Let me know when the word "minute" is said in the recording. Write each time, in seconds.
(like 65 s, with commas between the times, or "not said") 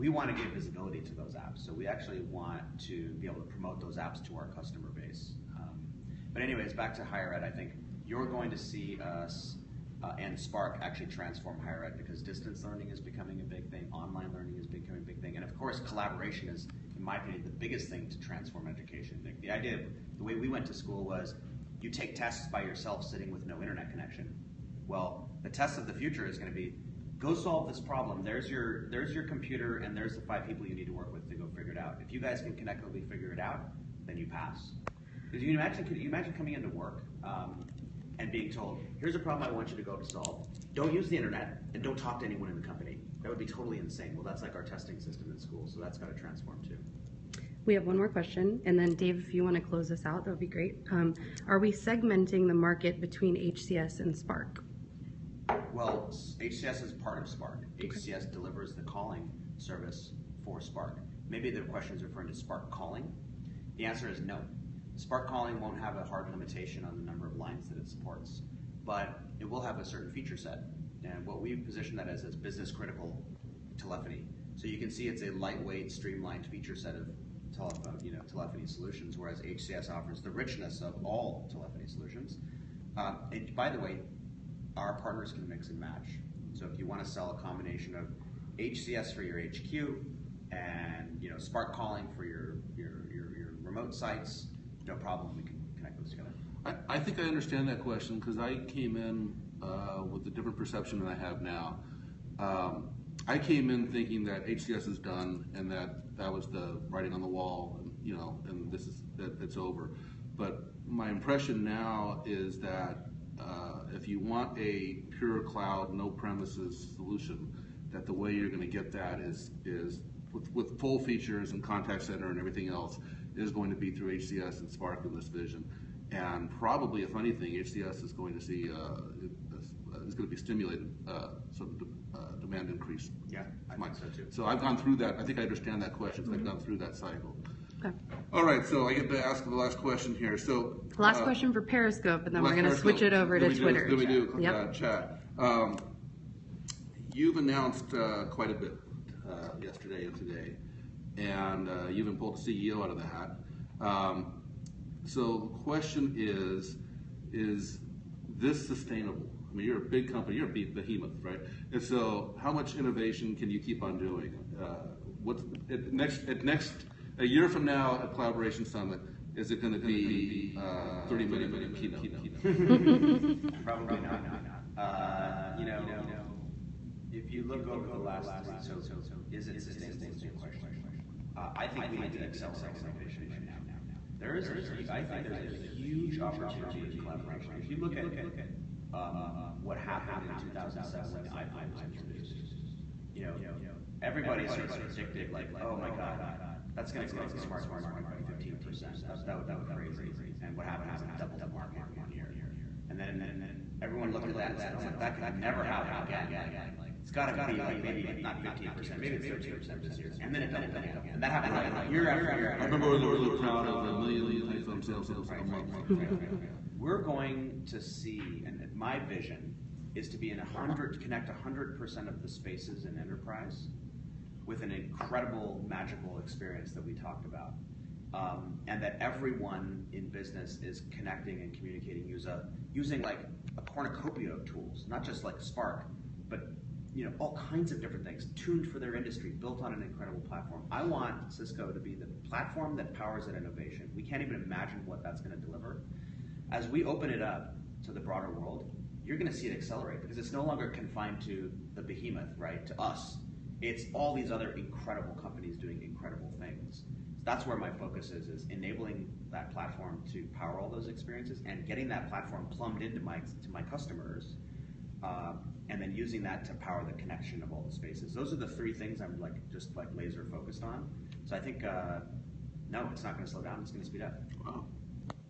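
171 s.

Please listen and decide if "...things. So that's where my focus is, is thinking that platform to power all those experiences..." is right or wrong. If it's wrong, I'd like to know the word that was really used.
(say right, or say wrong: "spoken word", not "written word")
wrong: "enabling", not "thinking".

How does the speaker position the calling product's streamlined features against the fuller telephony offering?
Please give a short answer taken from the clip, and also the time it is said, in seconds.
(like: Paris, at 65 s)
Business critical telephony, at 72 s.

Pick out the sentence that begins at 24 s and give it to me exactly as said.
Well, the test of the future is going to be go solve this problem.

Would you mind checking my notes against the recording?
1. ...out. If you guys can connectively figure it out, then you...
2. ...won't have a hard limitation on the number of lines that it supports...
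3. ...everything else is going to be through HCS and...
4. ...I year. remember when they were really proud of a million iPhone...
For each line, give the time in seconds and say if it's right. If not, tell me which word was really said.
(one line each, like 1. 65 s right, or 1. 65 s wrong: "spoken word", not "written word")
1. 31 s right
2. 65 s right
3. 122 s right
4. 212 s right.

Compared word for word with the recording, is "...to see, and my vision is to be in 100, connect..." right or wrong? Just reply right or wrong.
right.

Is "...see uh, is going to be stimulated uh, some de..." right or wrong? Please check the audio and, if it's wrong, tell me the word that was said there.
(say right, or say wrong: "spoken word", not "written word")
right.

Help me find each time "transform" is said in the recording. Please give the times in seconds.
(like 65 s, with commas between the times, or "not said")
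11 s, 18 s, 46 s.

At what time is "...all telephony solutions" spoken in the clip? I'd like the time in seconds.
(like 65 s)
81 s.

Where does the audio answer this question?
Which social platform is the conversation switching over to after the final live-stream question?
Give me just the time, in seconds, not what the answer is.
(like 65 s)
143 s.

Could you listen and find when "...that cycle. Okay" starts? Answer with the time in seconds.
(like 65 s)
136 s.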